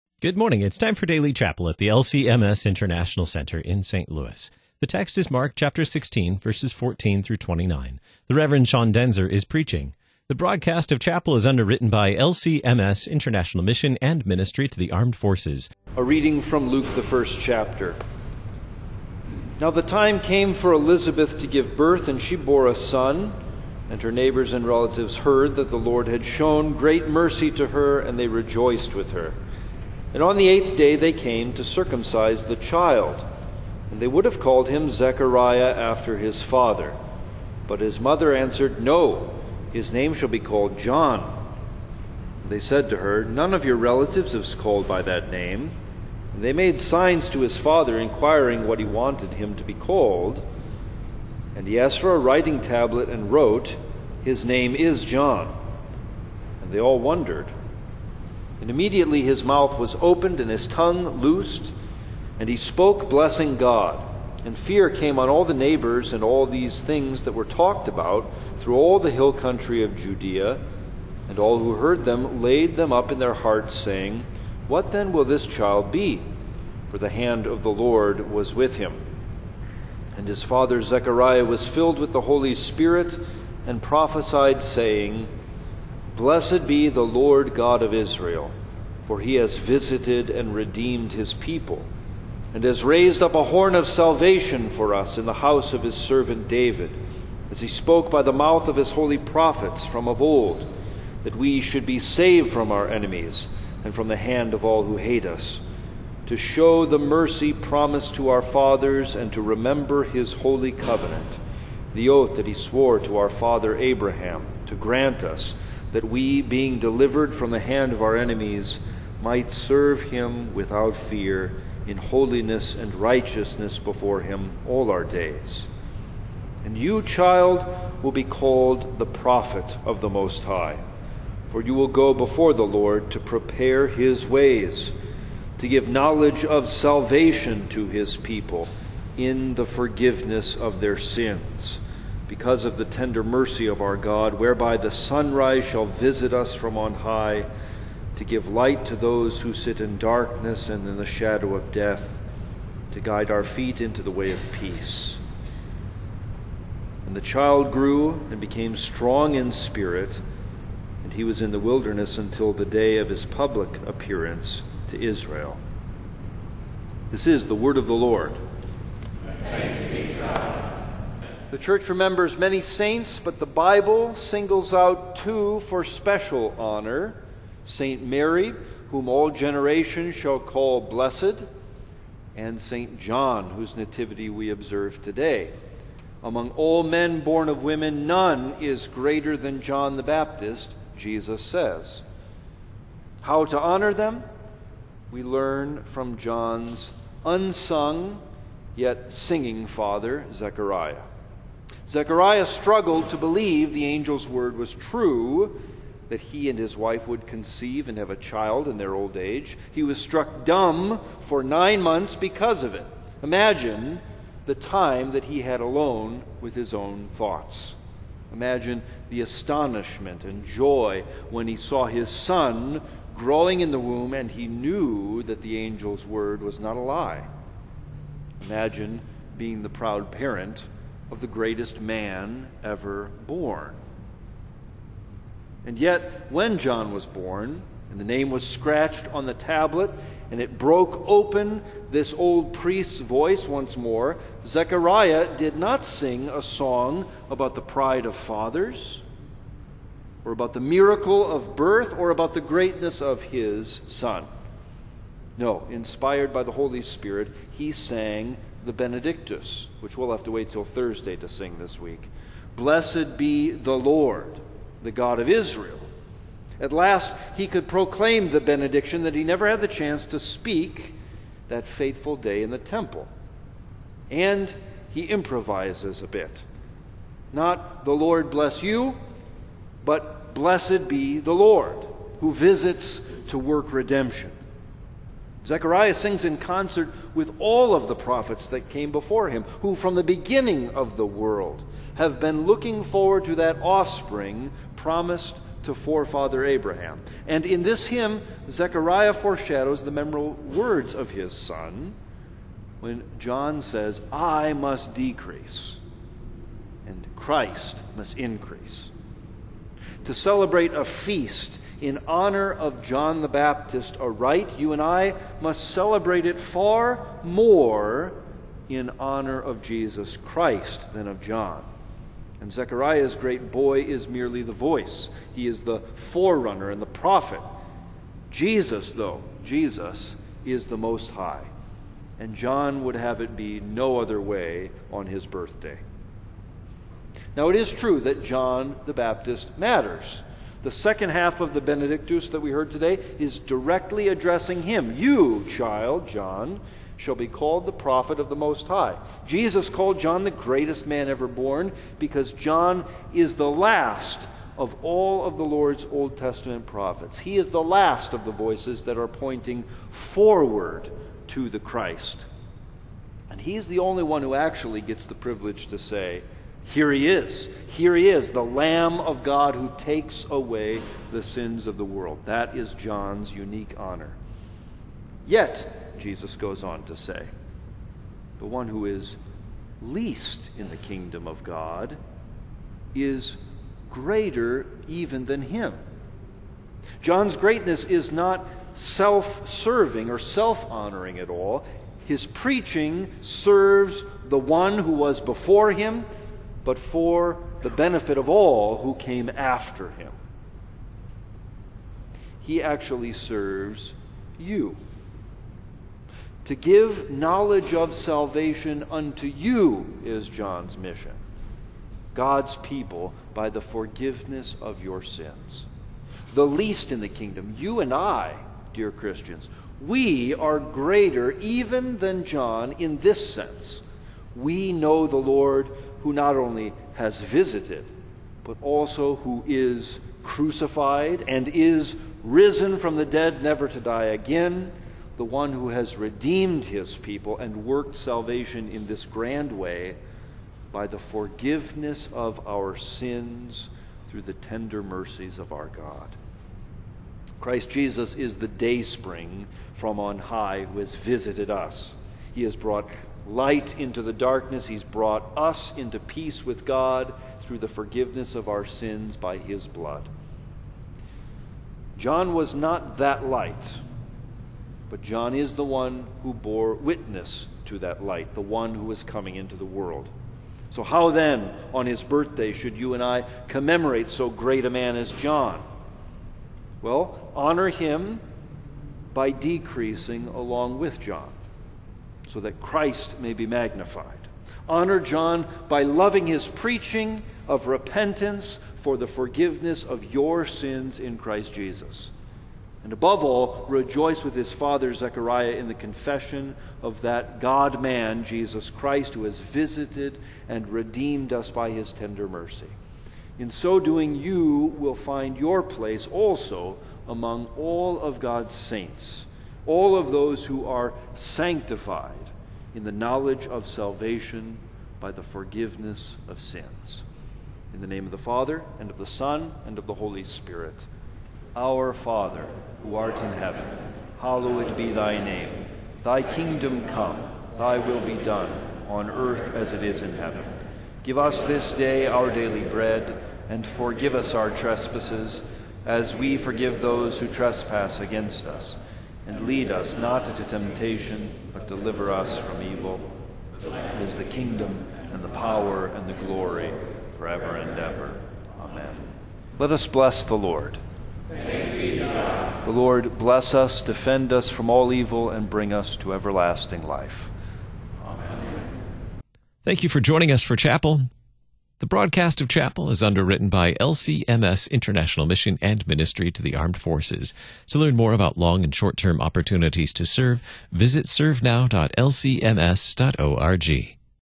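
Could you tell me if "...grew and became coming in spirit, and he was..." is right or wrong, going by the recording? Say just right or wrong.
wrong.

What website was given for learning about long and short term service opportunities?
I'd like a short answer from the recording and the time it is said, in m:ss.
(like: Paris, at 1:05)
servenow.lcms.org, at 9:31.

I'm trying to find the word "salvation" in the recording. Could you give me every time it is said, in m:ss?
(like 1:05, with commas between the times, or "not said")
1:33, 2:16, 6:47, 7:17, 8:33.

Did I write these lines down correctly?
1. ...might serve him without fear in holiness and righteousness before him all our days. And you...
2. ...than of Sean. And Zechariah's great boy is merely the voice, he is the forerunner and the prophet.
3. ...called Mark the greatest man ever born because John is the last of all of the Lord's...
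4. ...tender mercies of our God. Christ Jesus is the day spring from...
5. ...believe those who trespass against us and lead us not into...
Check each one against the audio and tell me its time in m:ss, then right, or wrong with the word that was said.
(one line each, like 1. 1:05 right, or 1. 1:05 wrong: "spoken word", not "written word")
1. 1:59 right
2. 5:20 wrong: "John", not "Sean"
3. 5:49 wrong: "John", not "Mark"
4. 7:24 right
5. 8:56 wrong: "forgive", not "believe".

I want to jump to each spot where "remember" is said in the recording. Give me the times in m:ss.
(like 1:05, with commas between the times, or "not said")
1:49, 2:51.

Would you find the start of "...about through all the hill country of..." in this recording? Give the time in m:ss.
1:07.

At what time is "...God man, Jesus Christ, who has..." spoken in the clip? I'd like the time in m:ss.
8:17.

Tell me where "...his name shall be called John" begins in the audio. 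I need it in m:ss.
0:39.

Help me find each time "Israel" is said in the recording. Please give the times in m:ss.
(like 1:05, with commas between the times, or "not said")
1:27, 2:45, 4:25.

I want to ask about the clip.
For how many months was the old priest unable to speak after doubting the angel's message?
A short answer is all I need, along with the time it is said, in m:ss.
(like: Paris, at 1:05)
9, at 3:31.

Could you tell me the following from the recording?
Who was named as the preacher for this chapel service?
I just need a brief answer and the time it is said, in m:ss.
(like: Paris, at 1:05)
Sean Daenzer, at 0:08.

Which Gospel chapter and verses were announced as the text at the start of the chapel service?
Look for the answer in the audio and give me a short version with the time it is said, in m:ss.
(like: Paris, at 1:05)
Mark 16:14-29, at 0:05.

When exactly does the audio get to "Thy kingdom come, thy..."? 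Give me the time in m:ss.
8:46.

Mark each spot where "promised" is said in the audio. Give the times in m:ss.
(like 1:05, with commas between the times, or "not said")
1:47, 4:54.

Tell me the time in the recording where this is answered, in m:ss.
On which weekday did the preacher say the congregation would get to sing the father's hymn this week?
4:20.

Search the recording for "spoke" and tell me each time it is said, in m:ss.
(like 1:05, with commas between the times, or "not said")
1:02, 1:37.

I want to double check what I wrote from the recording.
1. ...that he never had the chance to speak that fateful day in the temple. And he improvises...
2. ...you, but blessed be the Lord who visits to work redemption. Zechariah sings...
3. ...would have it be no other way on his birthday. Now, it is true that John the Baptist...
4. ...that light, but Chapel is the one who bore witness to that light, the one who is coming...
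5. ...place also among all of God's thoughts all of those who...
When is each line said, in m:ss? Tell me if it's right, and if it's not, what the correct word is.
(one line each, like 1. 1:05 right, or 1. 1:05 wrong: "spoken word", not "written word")
1. 4:29 right
2. 4:38 right
3. 5:32 right
4. 7:42 wrong: "John", not "Chapel"
5. 8:25 wrong: "saints", not "thoughts".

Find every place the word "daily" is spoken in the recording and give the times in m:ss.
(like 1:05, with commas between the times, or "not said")
0:01, 8:52.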